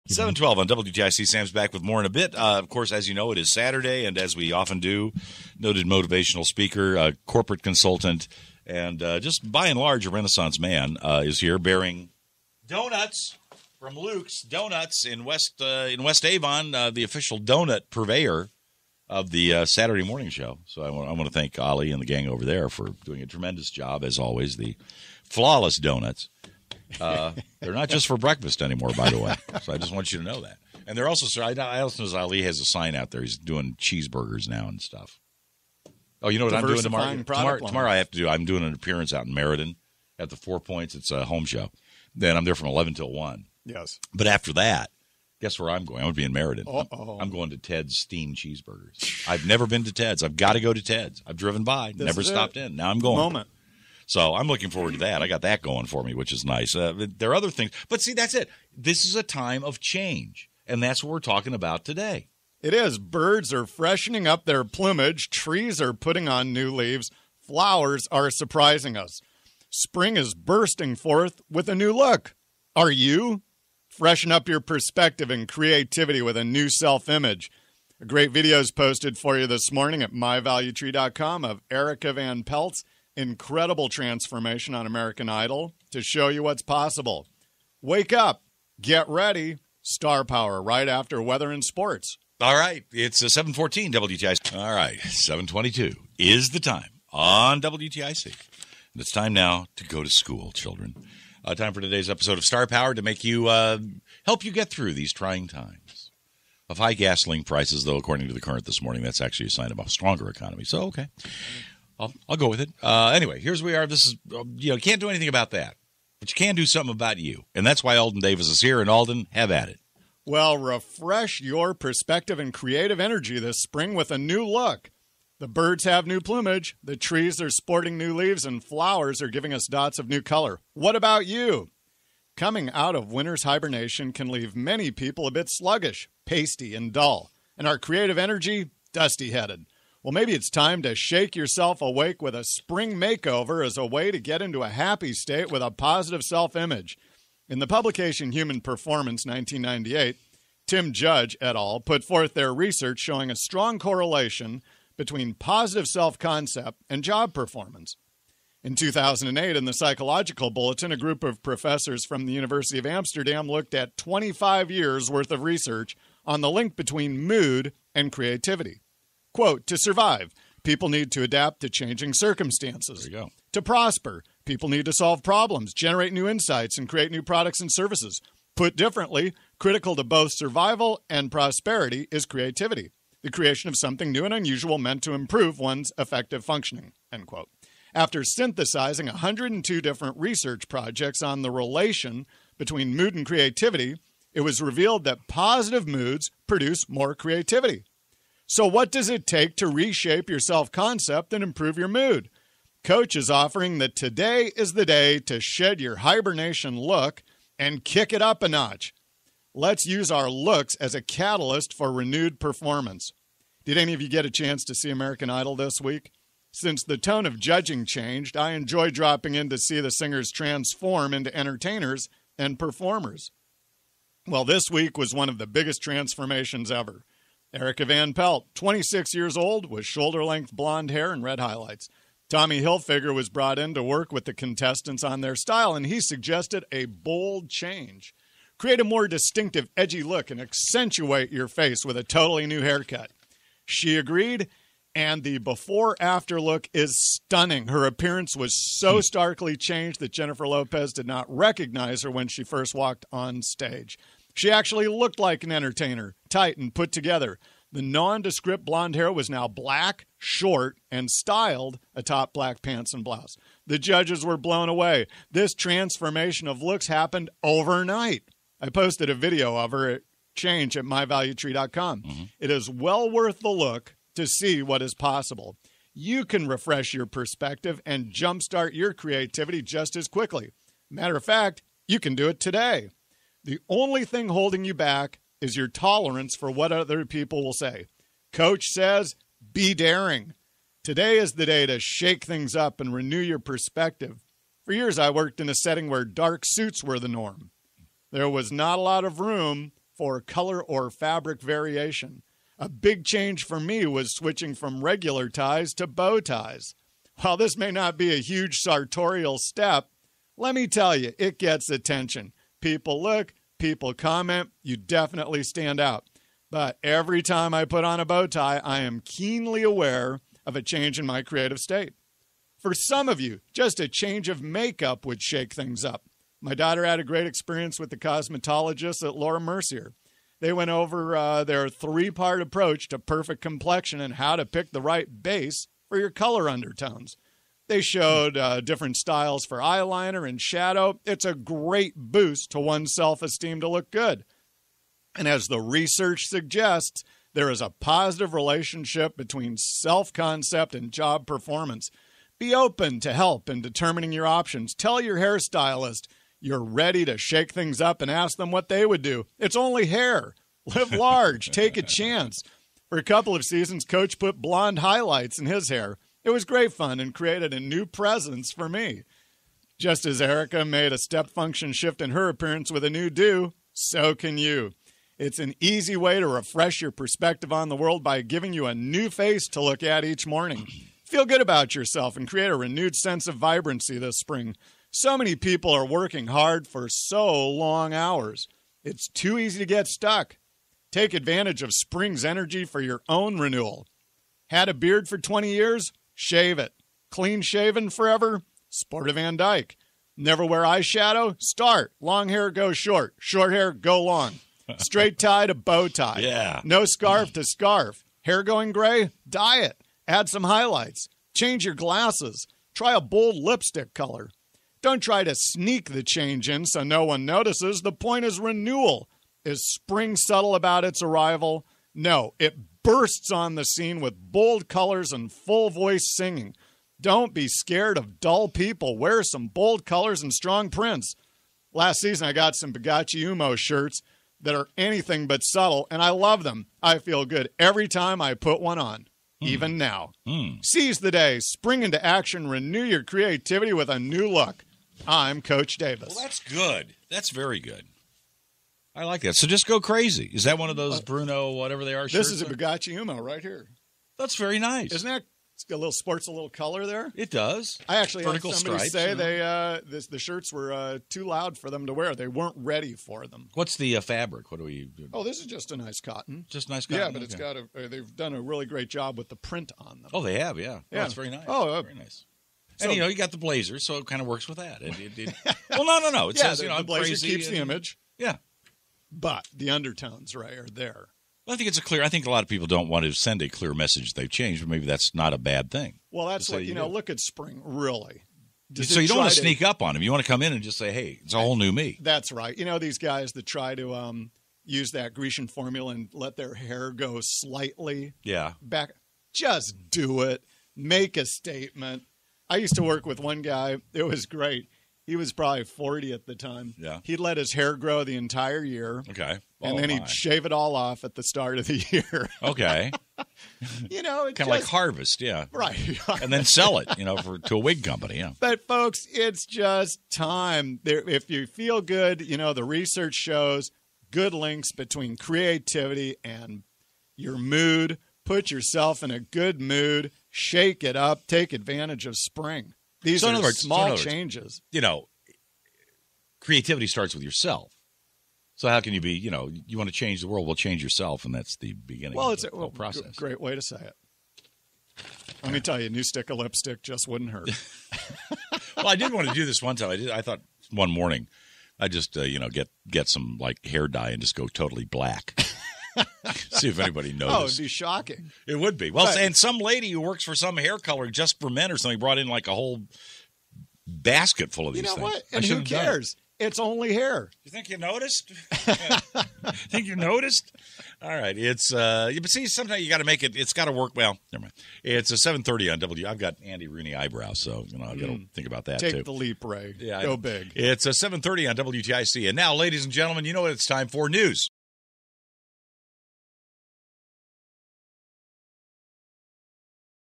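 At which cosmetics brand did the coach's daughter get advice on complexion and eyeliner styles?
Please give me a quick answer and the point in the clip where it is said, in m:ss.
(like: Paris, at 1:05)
Laura Mercier, at 5:29.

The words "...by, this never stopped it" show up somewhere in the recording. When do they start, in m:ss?
0:51.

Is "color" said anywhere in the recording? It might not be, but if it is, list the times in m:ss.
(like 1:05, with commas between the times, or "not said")
2:10, 5:00, 5:36, 6:53, 7:04, 7:09, 7:36, 9:20.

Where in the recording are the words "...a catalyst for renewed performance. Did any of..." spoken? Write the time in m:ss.
3:30.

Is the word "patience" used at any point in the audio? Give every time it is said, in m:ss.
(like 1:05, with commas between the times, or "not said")
not said.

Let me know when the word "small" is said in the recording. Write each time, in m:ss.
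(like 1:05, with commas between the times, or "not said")
8:53.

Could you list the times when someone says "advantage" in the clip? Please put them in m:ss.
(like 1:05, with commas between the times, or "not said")
6:31, 8:51.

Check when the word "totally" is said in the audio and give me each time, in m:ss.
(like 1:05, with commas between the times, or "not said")
4:02, 9:14.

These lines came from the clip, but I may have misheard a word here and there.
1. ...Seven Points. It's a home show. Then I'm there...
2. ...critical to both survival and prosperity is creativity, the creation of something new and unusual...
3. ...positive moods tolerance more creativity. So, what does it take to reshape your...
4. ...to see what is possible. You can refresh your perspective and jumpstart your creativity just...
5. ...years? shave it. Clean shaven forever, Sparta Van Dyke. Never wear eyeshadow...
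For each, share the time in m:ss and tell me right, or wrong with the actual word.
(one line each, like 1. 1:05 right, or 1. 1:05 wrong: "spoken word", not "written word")
1. 0:40 wrong: "Four", not "Seven"
2. 2:59 right
3. 3:15 wrong: "produce", not "tolerance"
4. 4:34 right
5. 6:35 right.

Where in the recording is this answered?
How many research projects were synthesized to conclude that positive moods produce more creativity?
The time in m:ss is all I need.
3:09.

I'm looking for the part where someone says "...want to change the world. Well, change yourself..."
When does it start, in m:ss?
8:59.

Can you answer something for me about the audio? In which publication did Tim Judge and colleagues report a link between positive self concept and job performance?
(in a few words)
Human Performance.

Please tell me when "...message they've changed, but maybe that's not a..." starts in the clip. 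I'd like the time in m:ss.
8:03.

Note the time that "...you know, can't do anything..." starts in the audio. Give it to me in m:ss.
1:54.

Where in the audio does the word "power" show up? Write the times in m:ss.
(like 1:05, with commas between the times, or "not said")
1:30, 1:42.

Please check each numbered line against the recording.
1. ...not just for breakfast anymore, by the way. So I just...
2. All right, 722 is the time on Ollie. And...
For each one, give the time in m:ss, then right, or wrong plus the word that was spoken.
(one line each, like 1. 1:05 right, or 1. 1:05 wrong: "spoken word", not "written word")
1. 0:27 right
2. 1:34 wrong: "WTIC", not "Ollie".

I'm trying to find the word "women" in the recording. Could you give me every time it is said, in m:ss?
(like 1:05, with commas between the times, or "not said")
not said.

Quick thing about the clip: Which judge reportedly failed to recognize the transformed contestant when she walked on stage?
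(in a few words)
Jennifer Lopez.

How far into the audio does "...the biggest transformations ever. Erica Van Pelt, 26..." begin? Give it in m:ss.
3:45.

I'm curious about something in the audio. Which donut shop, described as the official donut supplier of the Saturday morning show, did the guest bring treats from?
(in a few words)
Luke's Donuts.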